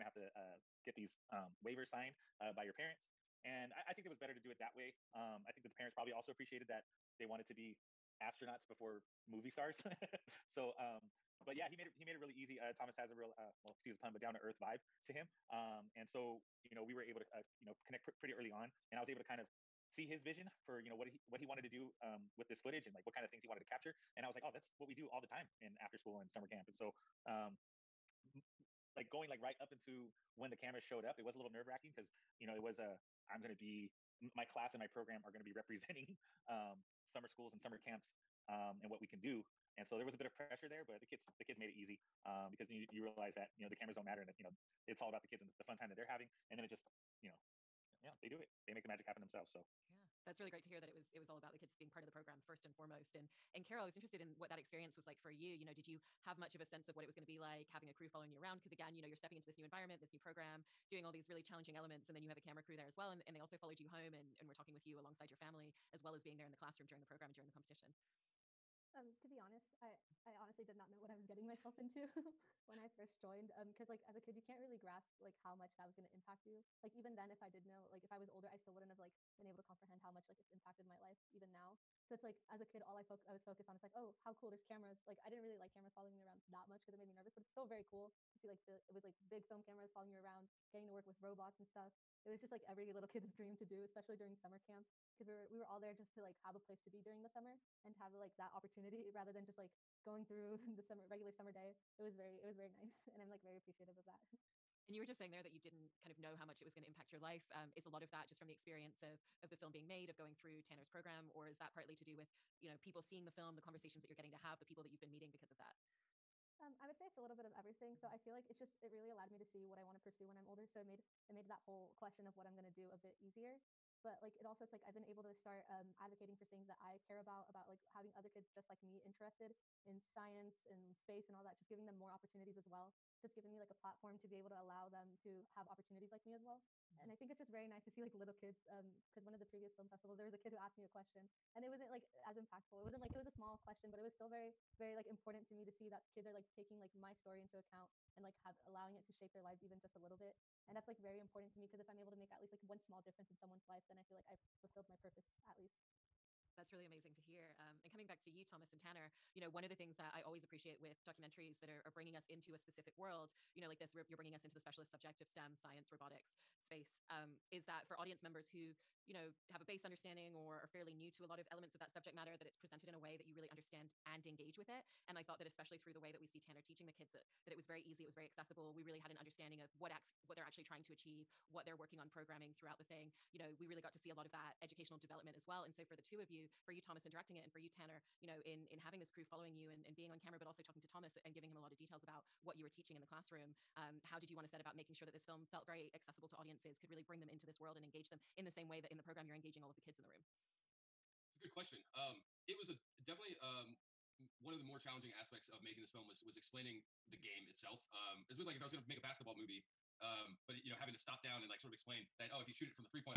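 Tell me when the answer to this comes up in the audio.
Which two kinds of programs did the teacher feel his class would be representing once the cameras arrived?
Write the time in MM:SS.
00:37.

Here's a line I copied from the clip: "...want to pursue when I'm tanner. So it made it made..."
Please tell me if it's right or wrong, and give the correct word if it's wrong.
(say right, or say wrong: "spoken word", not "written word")
wrong: "older", not "tanner".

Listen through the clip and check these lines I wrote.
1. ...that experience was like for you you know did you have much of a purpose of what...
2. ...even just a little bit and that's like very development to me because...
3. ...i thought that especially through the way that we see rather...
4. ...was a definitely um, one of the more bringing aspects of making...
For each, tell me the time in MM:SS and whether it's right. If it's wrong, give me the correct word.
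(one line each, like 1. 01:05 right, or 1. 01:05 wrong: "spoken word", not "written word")
1. 00:54 wrong: "sense", not "purpose"
2. 02:29 wrong: "important", not "development"
3. 02:55 wrong: "tanner", not "rather"
4. 03:22 wrong: "challenging", not "bringing".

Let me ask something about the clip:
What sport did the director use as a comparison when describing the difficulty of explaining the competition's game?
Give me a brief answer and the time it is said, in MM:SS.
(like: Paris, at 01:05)
basketball, at 03:29.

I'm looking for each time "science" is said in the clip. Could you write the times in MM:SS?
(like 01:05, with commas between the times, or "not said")
02:10, 02:45.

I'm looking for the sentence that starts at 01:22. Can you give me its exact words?
So it's like as a kid, all I fo- I was focused on is like, oh, how cool!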